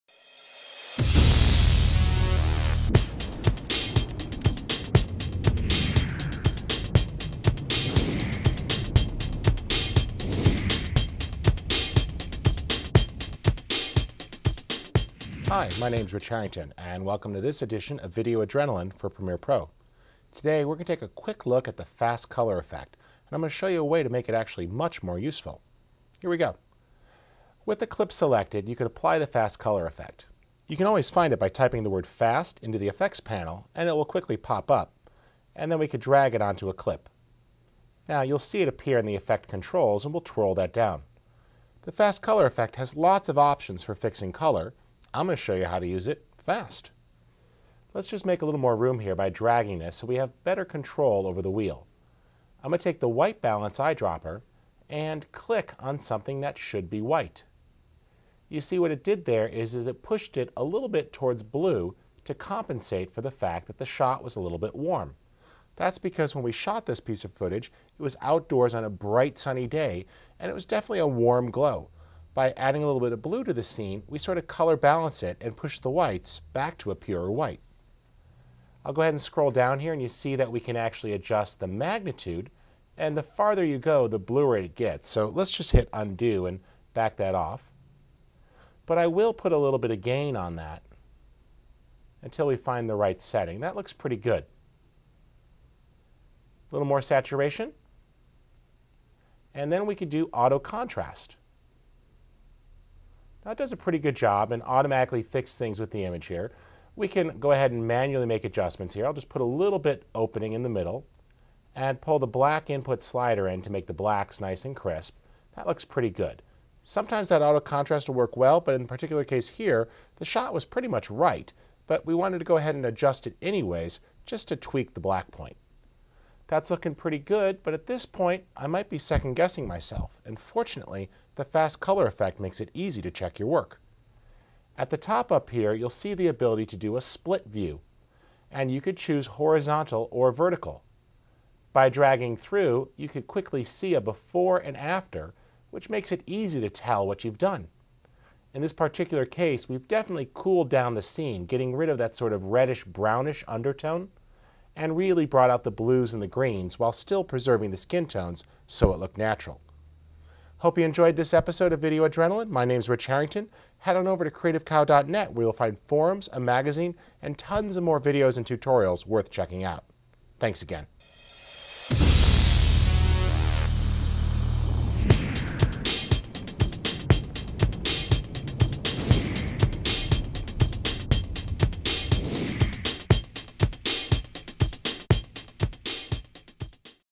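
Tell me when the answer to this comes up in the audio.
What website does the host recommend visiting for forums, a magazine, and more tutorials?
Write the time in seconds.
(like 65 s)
164 s.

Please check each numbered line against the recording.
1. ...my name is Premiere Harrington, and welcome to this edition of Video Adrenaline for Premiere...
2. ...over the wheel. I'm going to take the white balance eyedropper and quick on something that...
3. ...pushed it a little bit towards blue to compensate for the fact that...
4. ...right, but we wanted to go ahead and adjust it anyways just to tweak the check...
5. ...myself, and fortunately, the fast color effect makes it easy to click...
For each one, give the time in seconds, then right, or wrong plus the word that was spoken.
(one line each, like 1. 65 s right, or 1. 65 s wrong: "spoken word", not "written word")
1. 15 s wrong: "Rich", not "Premiere"
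2. 51 s wrong: "click", not "quick"
3. 60 s right
4. 121 s wrong: "black", not "check"
5. 129 s wrong: "check", not "click".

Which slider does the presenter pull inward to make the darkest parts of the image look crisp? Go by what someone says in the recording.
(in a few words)
black input slider.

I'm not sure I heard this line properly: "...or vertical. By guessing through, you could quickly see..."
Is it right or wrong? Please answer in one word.
wrong.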